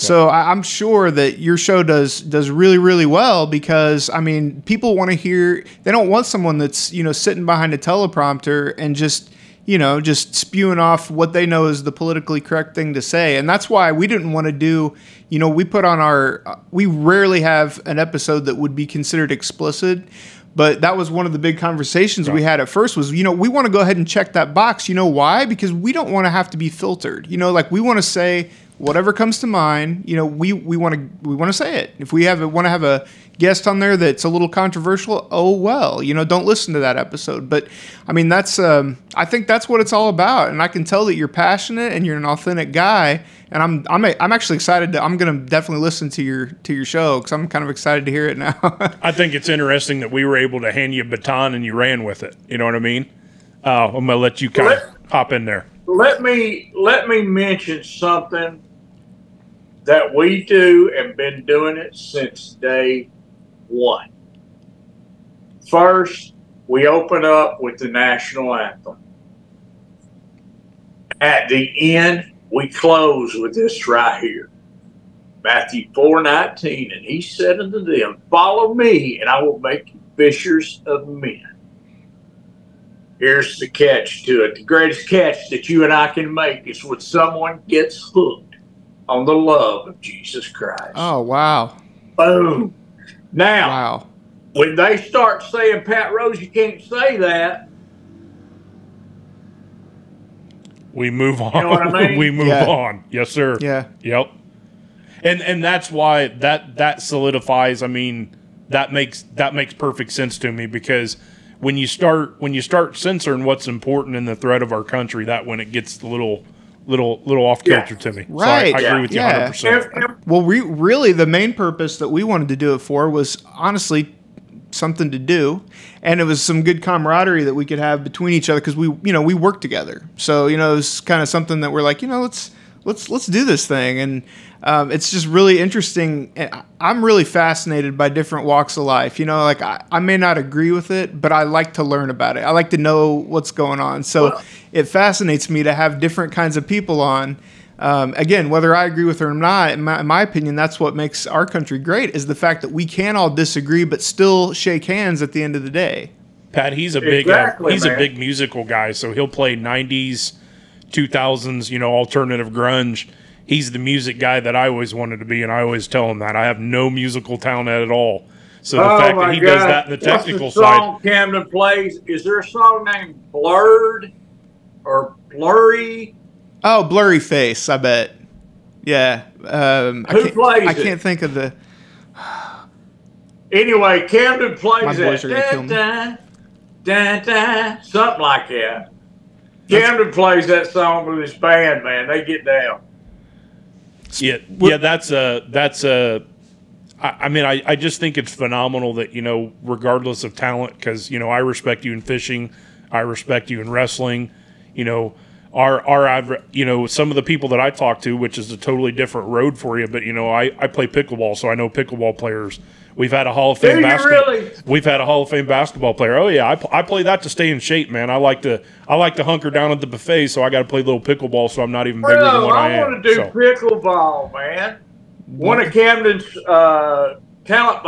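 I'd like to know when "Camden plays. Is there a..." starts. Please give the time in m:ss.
2:51.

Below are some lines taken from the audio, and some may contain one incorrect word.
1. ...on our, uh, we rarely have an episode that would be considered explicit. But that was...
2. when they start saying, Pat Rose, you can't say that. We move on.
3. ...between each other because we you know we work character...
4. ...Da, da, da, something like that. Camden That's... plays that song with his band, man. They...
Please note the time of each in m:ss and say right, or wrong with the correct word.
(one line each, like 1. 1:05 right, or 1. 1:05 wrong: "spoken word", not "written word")
1. 0:15 right
2. 1:34 right
3. 2:08 wrong: "together", not "character"
4. 3:05 right.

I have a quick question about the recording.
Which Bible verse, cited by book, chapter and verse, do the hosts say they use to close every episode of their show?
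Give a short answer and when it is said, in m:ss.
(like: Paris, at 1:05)
Matthew 4:19, at 1:15.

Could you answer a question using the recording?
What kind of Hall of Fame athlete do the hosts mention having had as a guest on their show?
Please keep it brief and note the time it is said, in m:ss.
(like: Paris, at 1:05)
Basketball player, at 3:35.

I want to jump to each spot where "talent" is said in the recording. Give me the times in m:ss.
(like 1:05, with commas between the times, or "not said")
2:47, 3:20.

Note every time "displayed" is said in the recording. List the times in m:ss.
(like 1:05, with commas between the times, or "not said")
not said.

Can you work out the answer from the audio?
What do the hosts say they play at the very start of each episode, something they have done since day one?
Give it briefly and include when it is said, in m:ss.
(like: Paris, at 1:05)
The national anthem, at 1:07.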